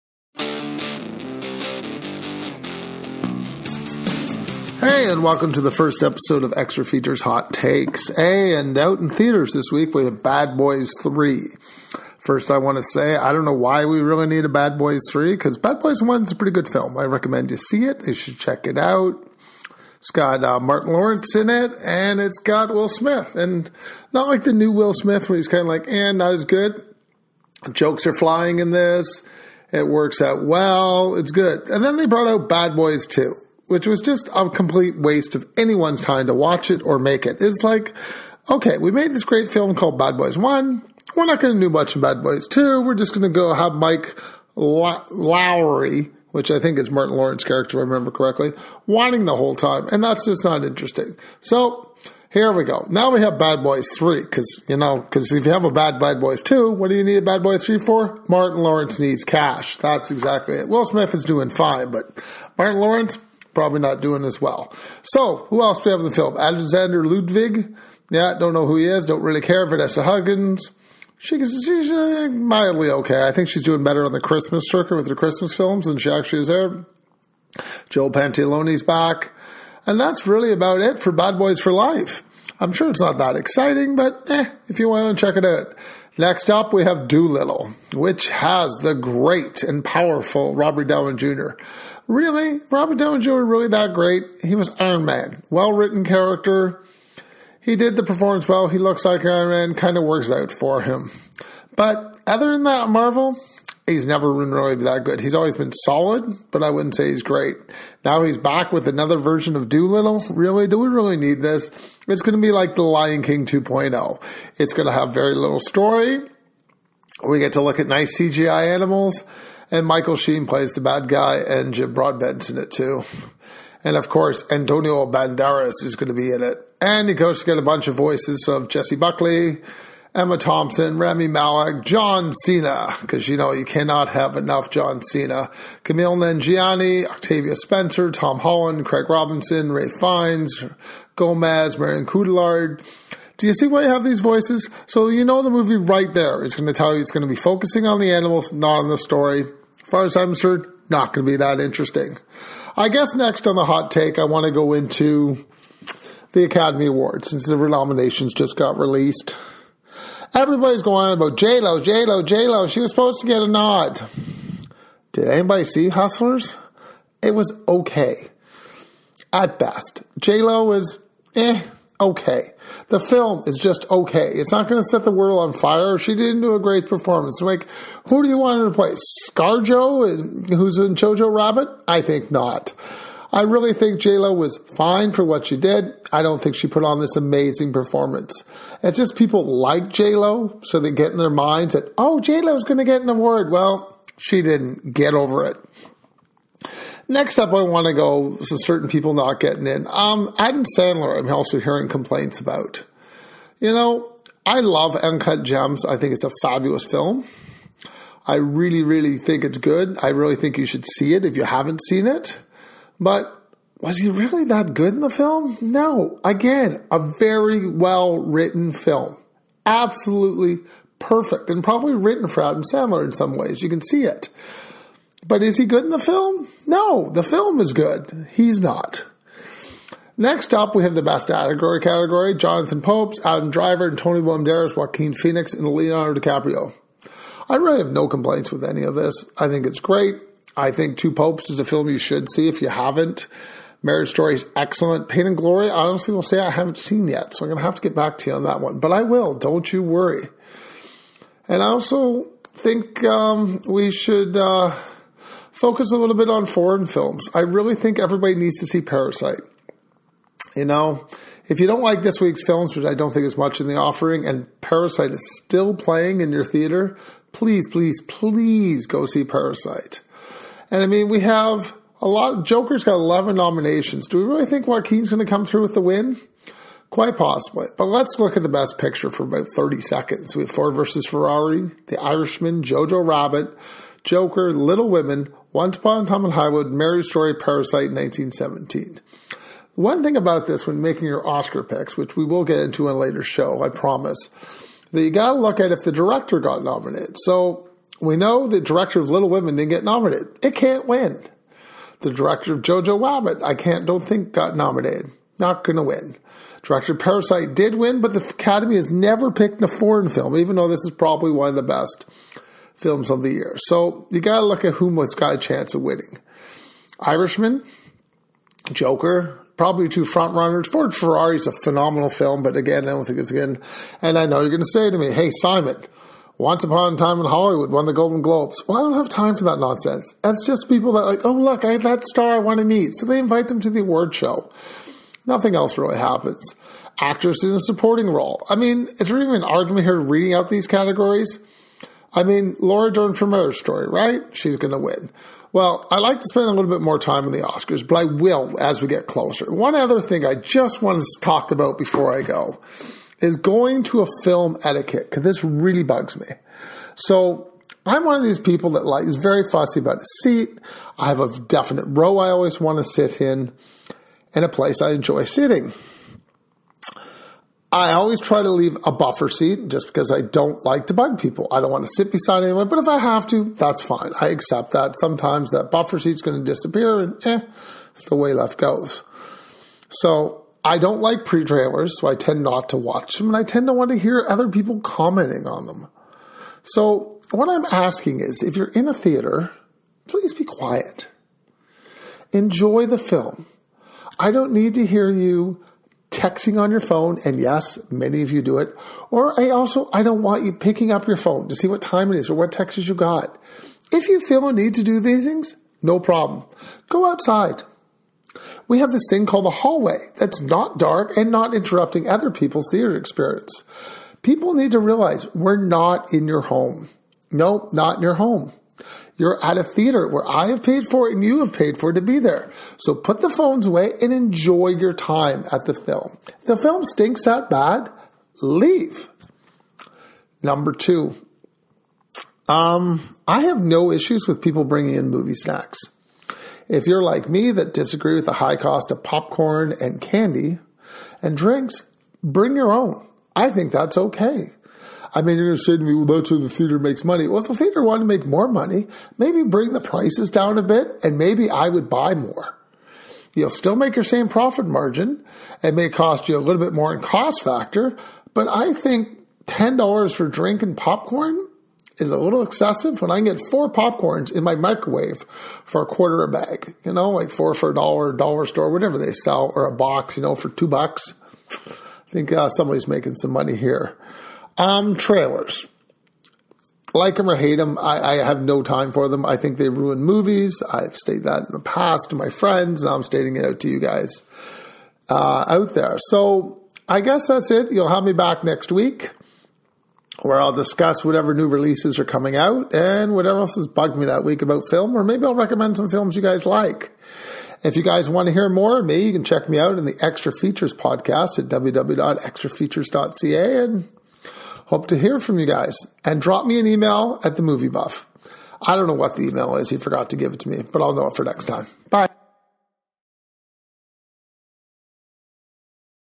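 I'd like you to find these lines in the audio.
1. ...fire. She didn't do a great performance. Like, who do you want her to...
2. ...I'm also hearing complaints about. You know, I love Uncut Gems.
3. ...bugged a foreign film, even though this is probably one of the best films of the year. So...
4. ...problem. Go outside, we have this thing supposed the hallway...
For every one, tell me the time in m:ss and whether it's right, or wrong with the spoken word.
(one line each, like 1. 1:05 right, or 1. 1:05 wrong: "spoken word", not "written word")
1. 2:55 right
2. 3:21 right
3. 5:09 wrong: "picked", not "bugged"
4. 6:45 wrong: "called", not "supposed".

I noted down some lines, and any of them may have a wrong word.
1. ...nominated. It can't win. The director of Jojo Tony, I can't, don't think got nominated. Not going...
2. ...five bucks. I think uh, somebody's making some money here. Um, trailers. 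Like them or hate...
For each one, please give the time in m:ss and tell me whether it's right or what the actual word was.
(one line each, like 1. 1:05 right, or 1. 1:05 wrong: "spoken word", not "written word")
1. 4:59 wrong: "Rabbit", not "Tony"
2. 7:50 wrong: "two", not "five".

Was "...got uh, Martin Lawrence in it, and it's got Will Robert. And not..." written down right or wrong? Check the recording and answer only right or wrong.
wrong.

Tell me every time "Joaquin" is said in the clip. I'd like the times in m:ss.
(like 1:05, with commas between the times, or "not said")
3:54, 4:34.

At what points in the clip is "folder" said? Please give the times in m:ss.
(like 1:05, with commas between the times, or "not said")
not said.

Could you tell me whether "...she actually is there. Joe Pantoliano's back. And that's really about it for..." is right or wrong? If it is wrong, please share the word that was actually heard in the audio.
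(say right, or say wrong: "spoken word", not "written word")
right.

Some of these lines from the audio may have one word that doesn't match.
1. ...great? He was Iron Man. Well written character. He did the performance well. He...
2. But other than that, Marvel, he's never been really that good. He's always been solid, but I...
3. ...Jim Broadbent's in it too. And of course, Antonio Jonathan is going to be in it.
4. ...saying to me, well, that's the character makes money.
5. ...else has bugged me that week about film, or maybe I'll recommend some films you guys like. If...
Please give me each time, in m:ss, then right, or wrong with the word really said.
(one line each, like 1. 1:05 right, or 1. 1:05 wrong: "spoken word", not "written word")
1. 1:33 right
2. 1:41 right
3. 2:01 wrong: "Banderas", not "Jonathan"
4. 7:25 wrong: "theater", not "character"
5. 8:13 right.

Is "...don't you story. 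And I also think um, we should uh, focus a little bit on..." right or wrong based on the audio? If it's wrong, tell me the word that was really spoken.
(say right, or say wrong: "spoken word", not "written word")
wrong: "worry", not "story".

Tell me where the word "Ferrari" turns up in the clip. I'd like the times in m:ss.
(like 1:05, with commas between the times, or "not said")
4:41, 5:20.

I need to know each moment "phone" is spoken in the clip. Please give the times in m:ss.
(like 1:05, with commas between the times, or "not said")
6:36, 6:41, 7:03.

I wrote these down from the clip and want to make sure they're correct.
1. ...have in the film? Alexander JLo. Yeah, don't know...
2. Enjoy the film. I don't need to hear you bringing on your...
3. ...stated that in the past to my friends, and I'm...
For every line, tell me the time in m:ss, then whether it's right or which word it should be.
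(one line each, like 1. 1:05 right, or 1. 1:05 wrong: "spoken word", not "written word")
1. 1:05 wrong: "Ludwig", not "JLo"
2. 6:32 wrong: "texting", not "bringing"
3. 8:00 right.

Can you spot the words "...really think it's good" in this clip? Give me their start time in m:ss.
3:28.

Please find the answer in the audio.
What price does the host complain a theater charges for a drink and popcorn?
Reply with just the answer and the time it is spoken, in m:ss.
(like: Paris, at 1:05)
$10, at 7:39.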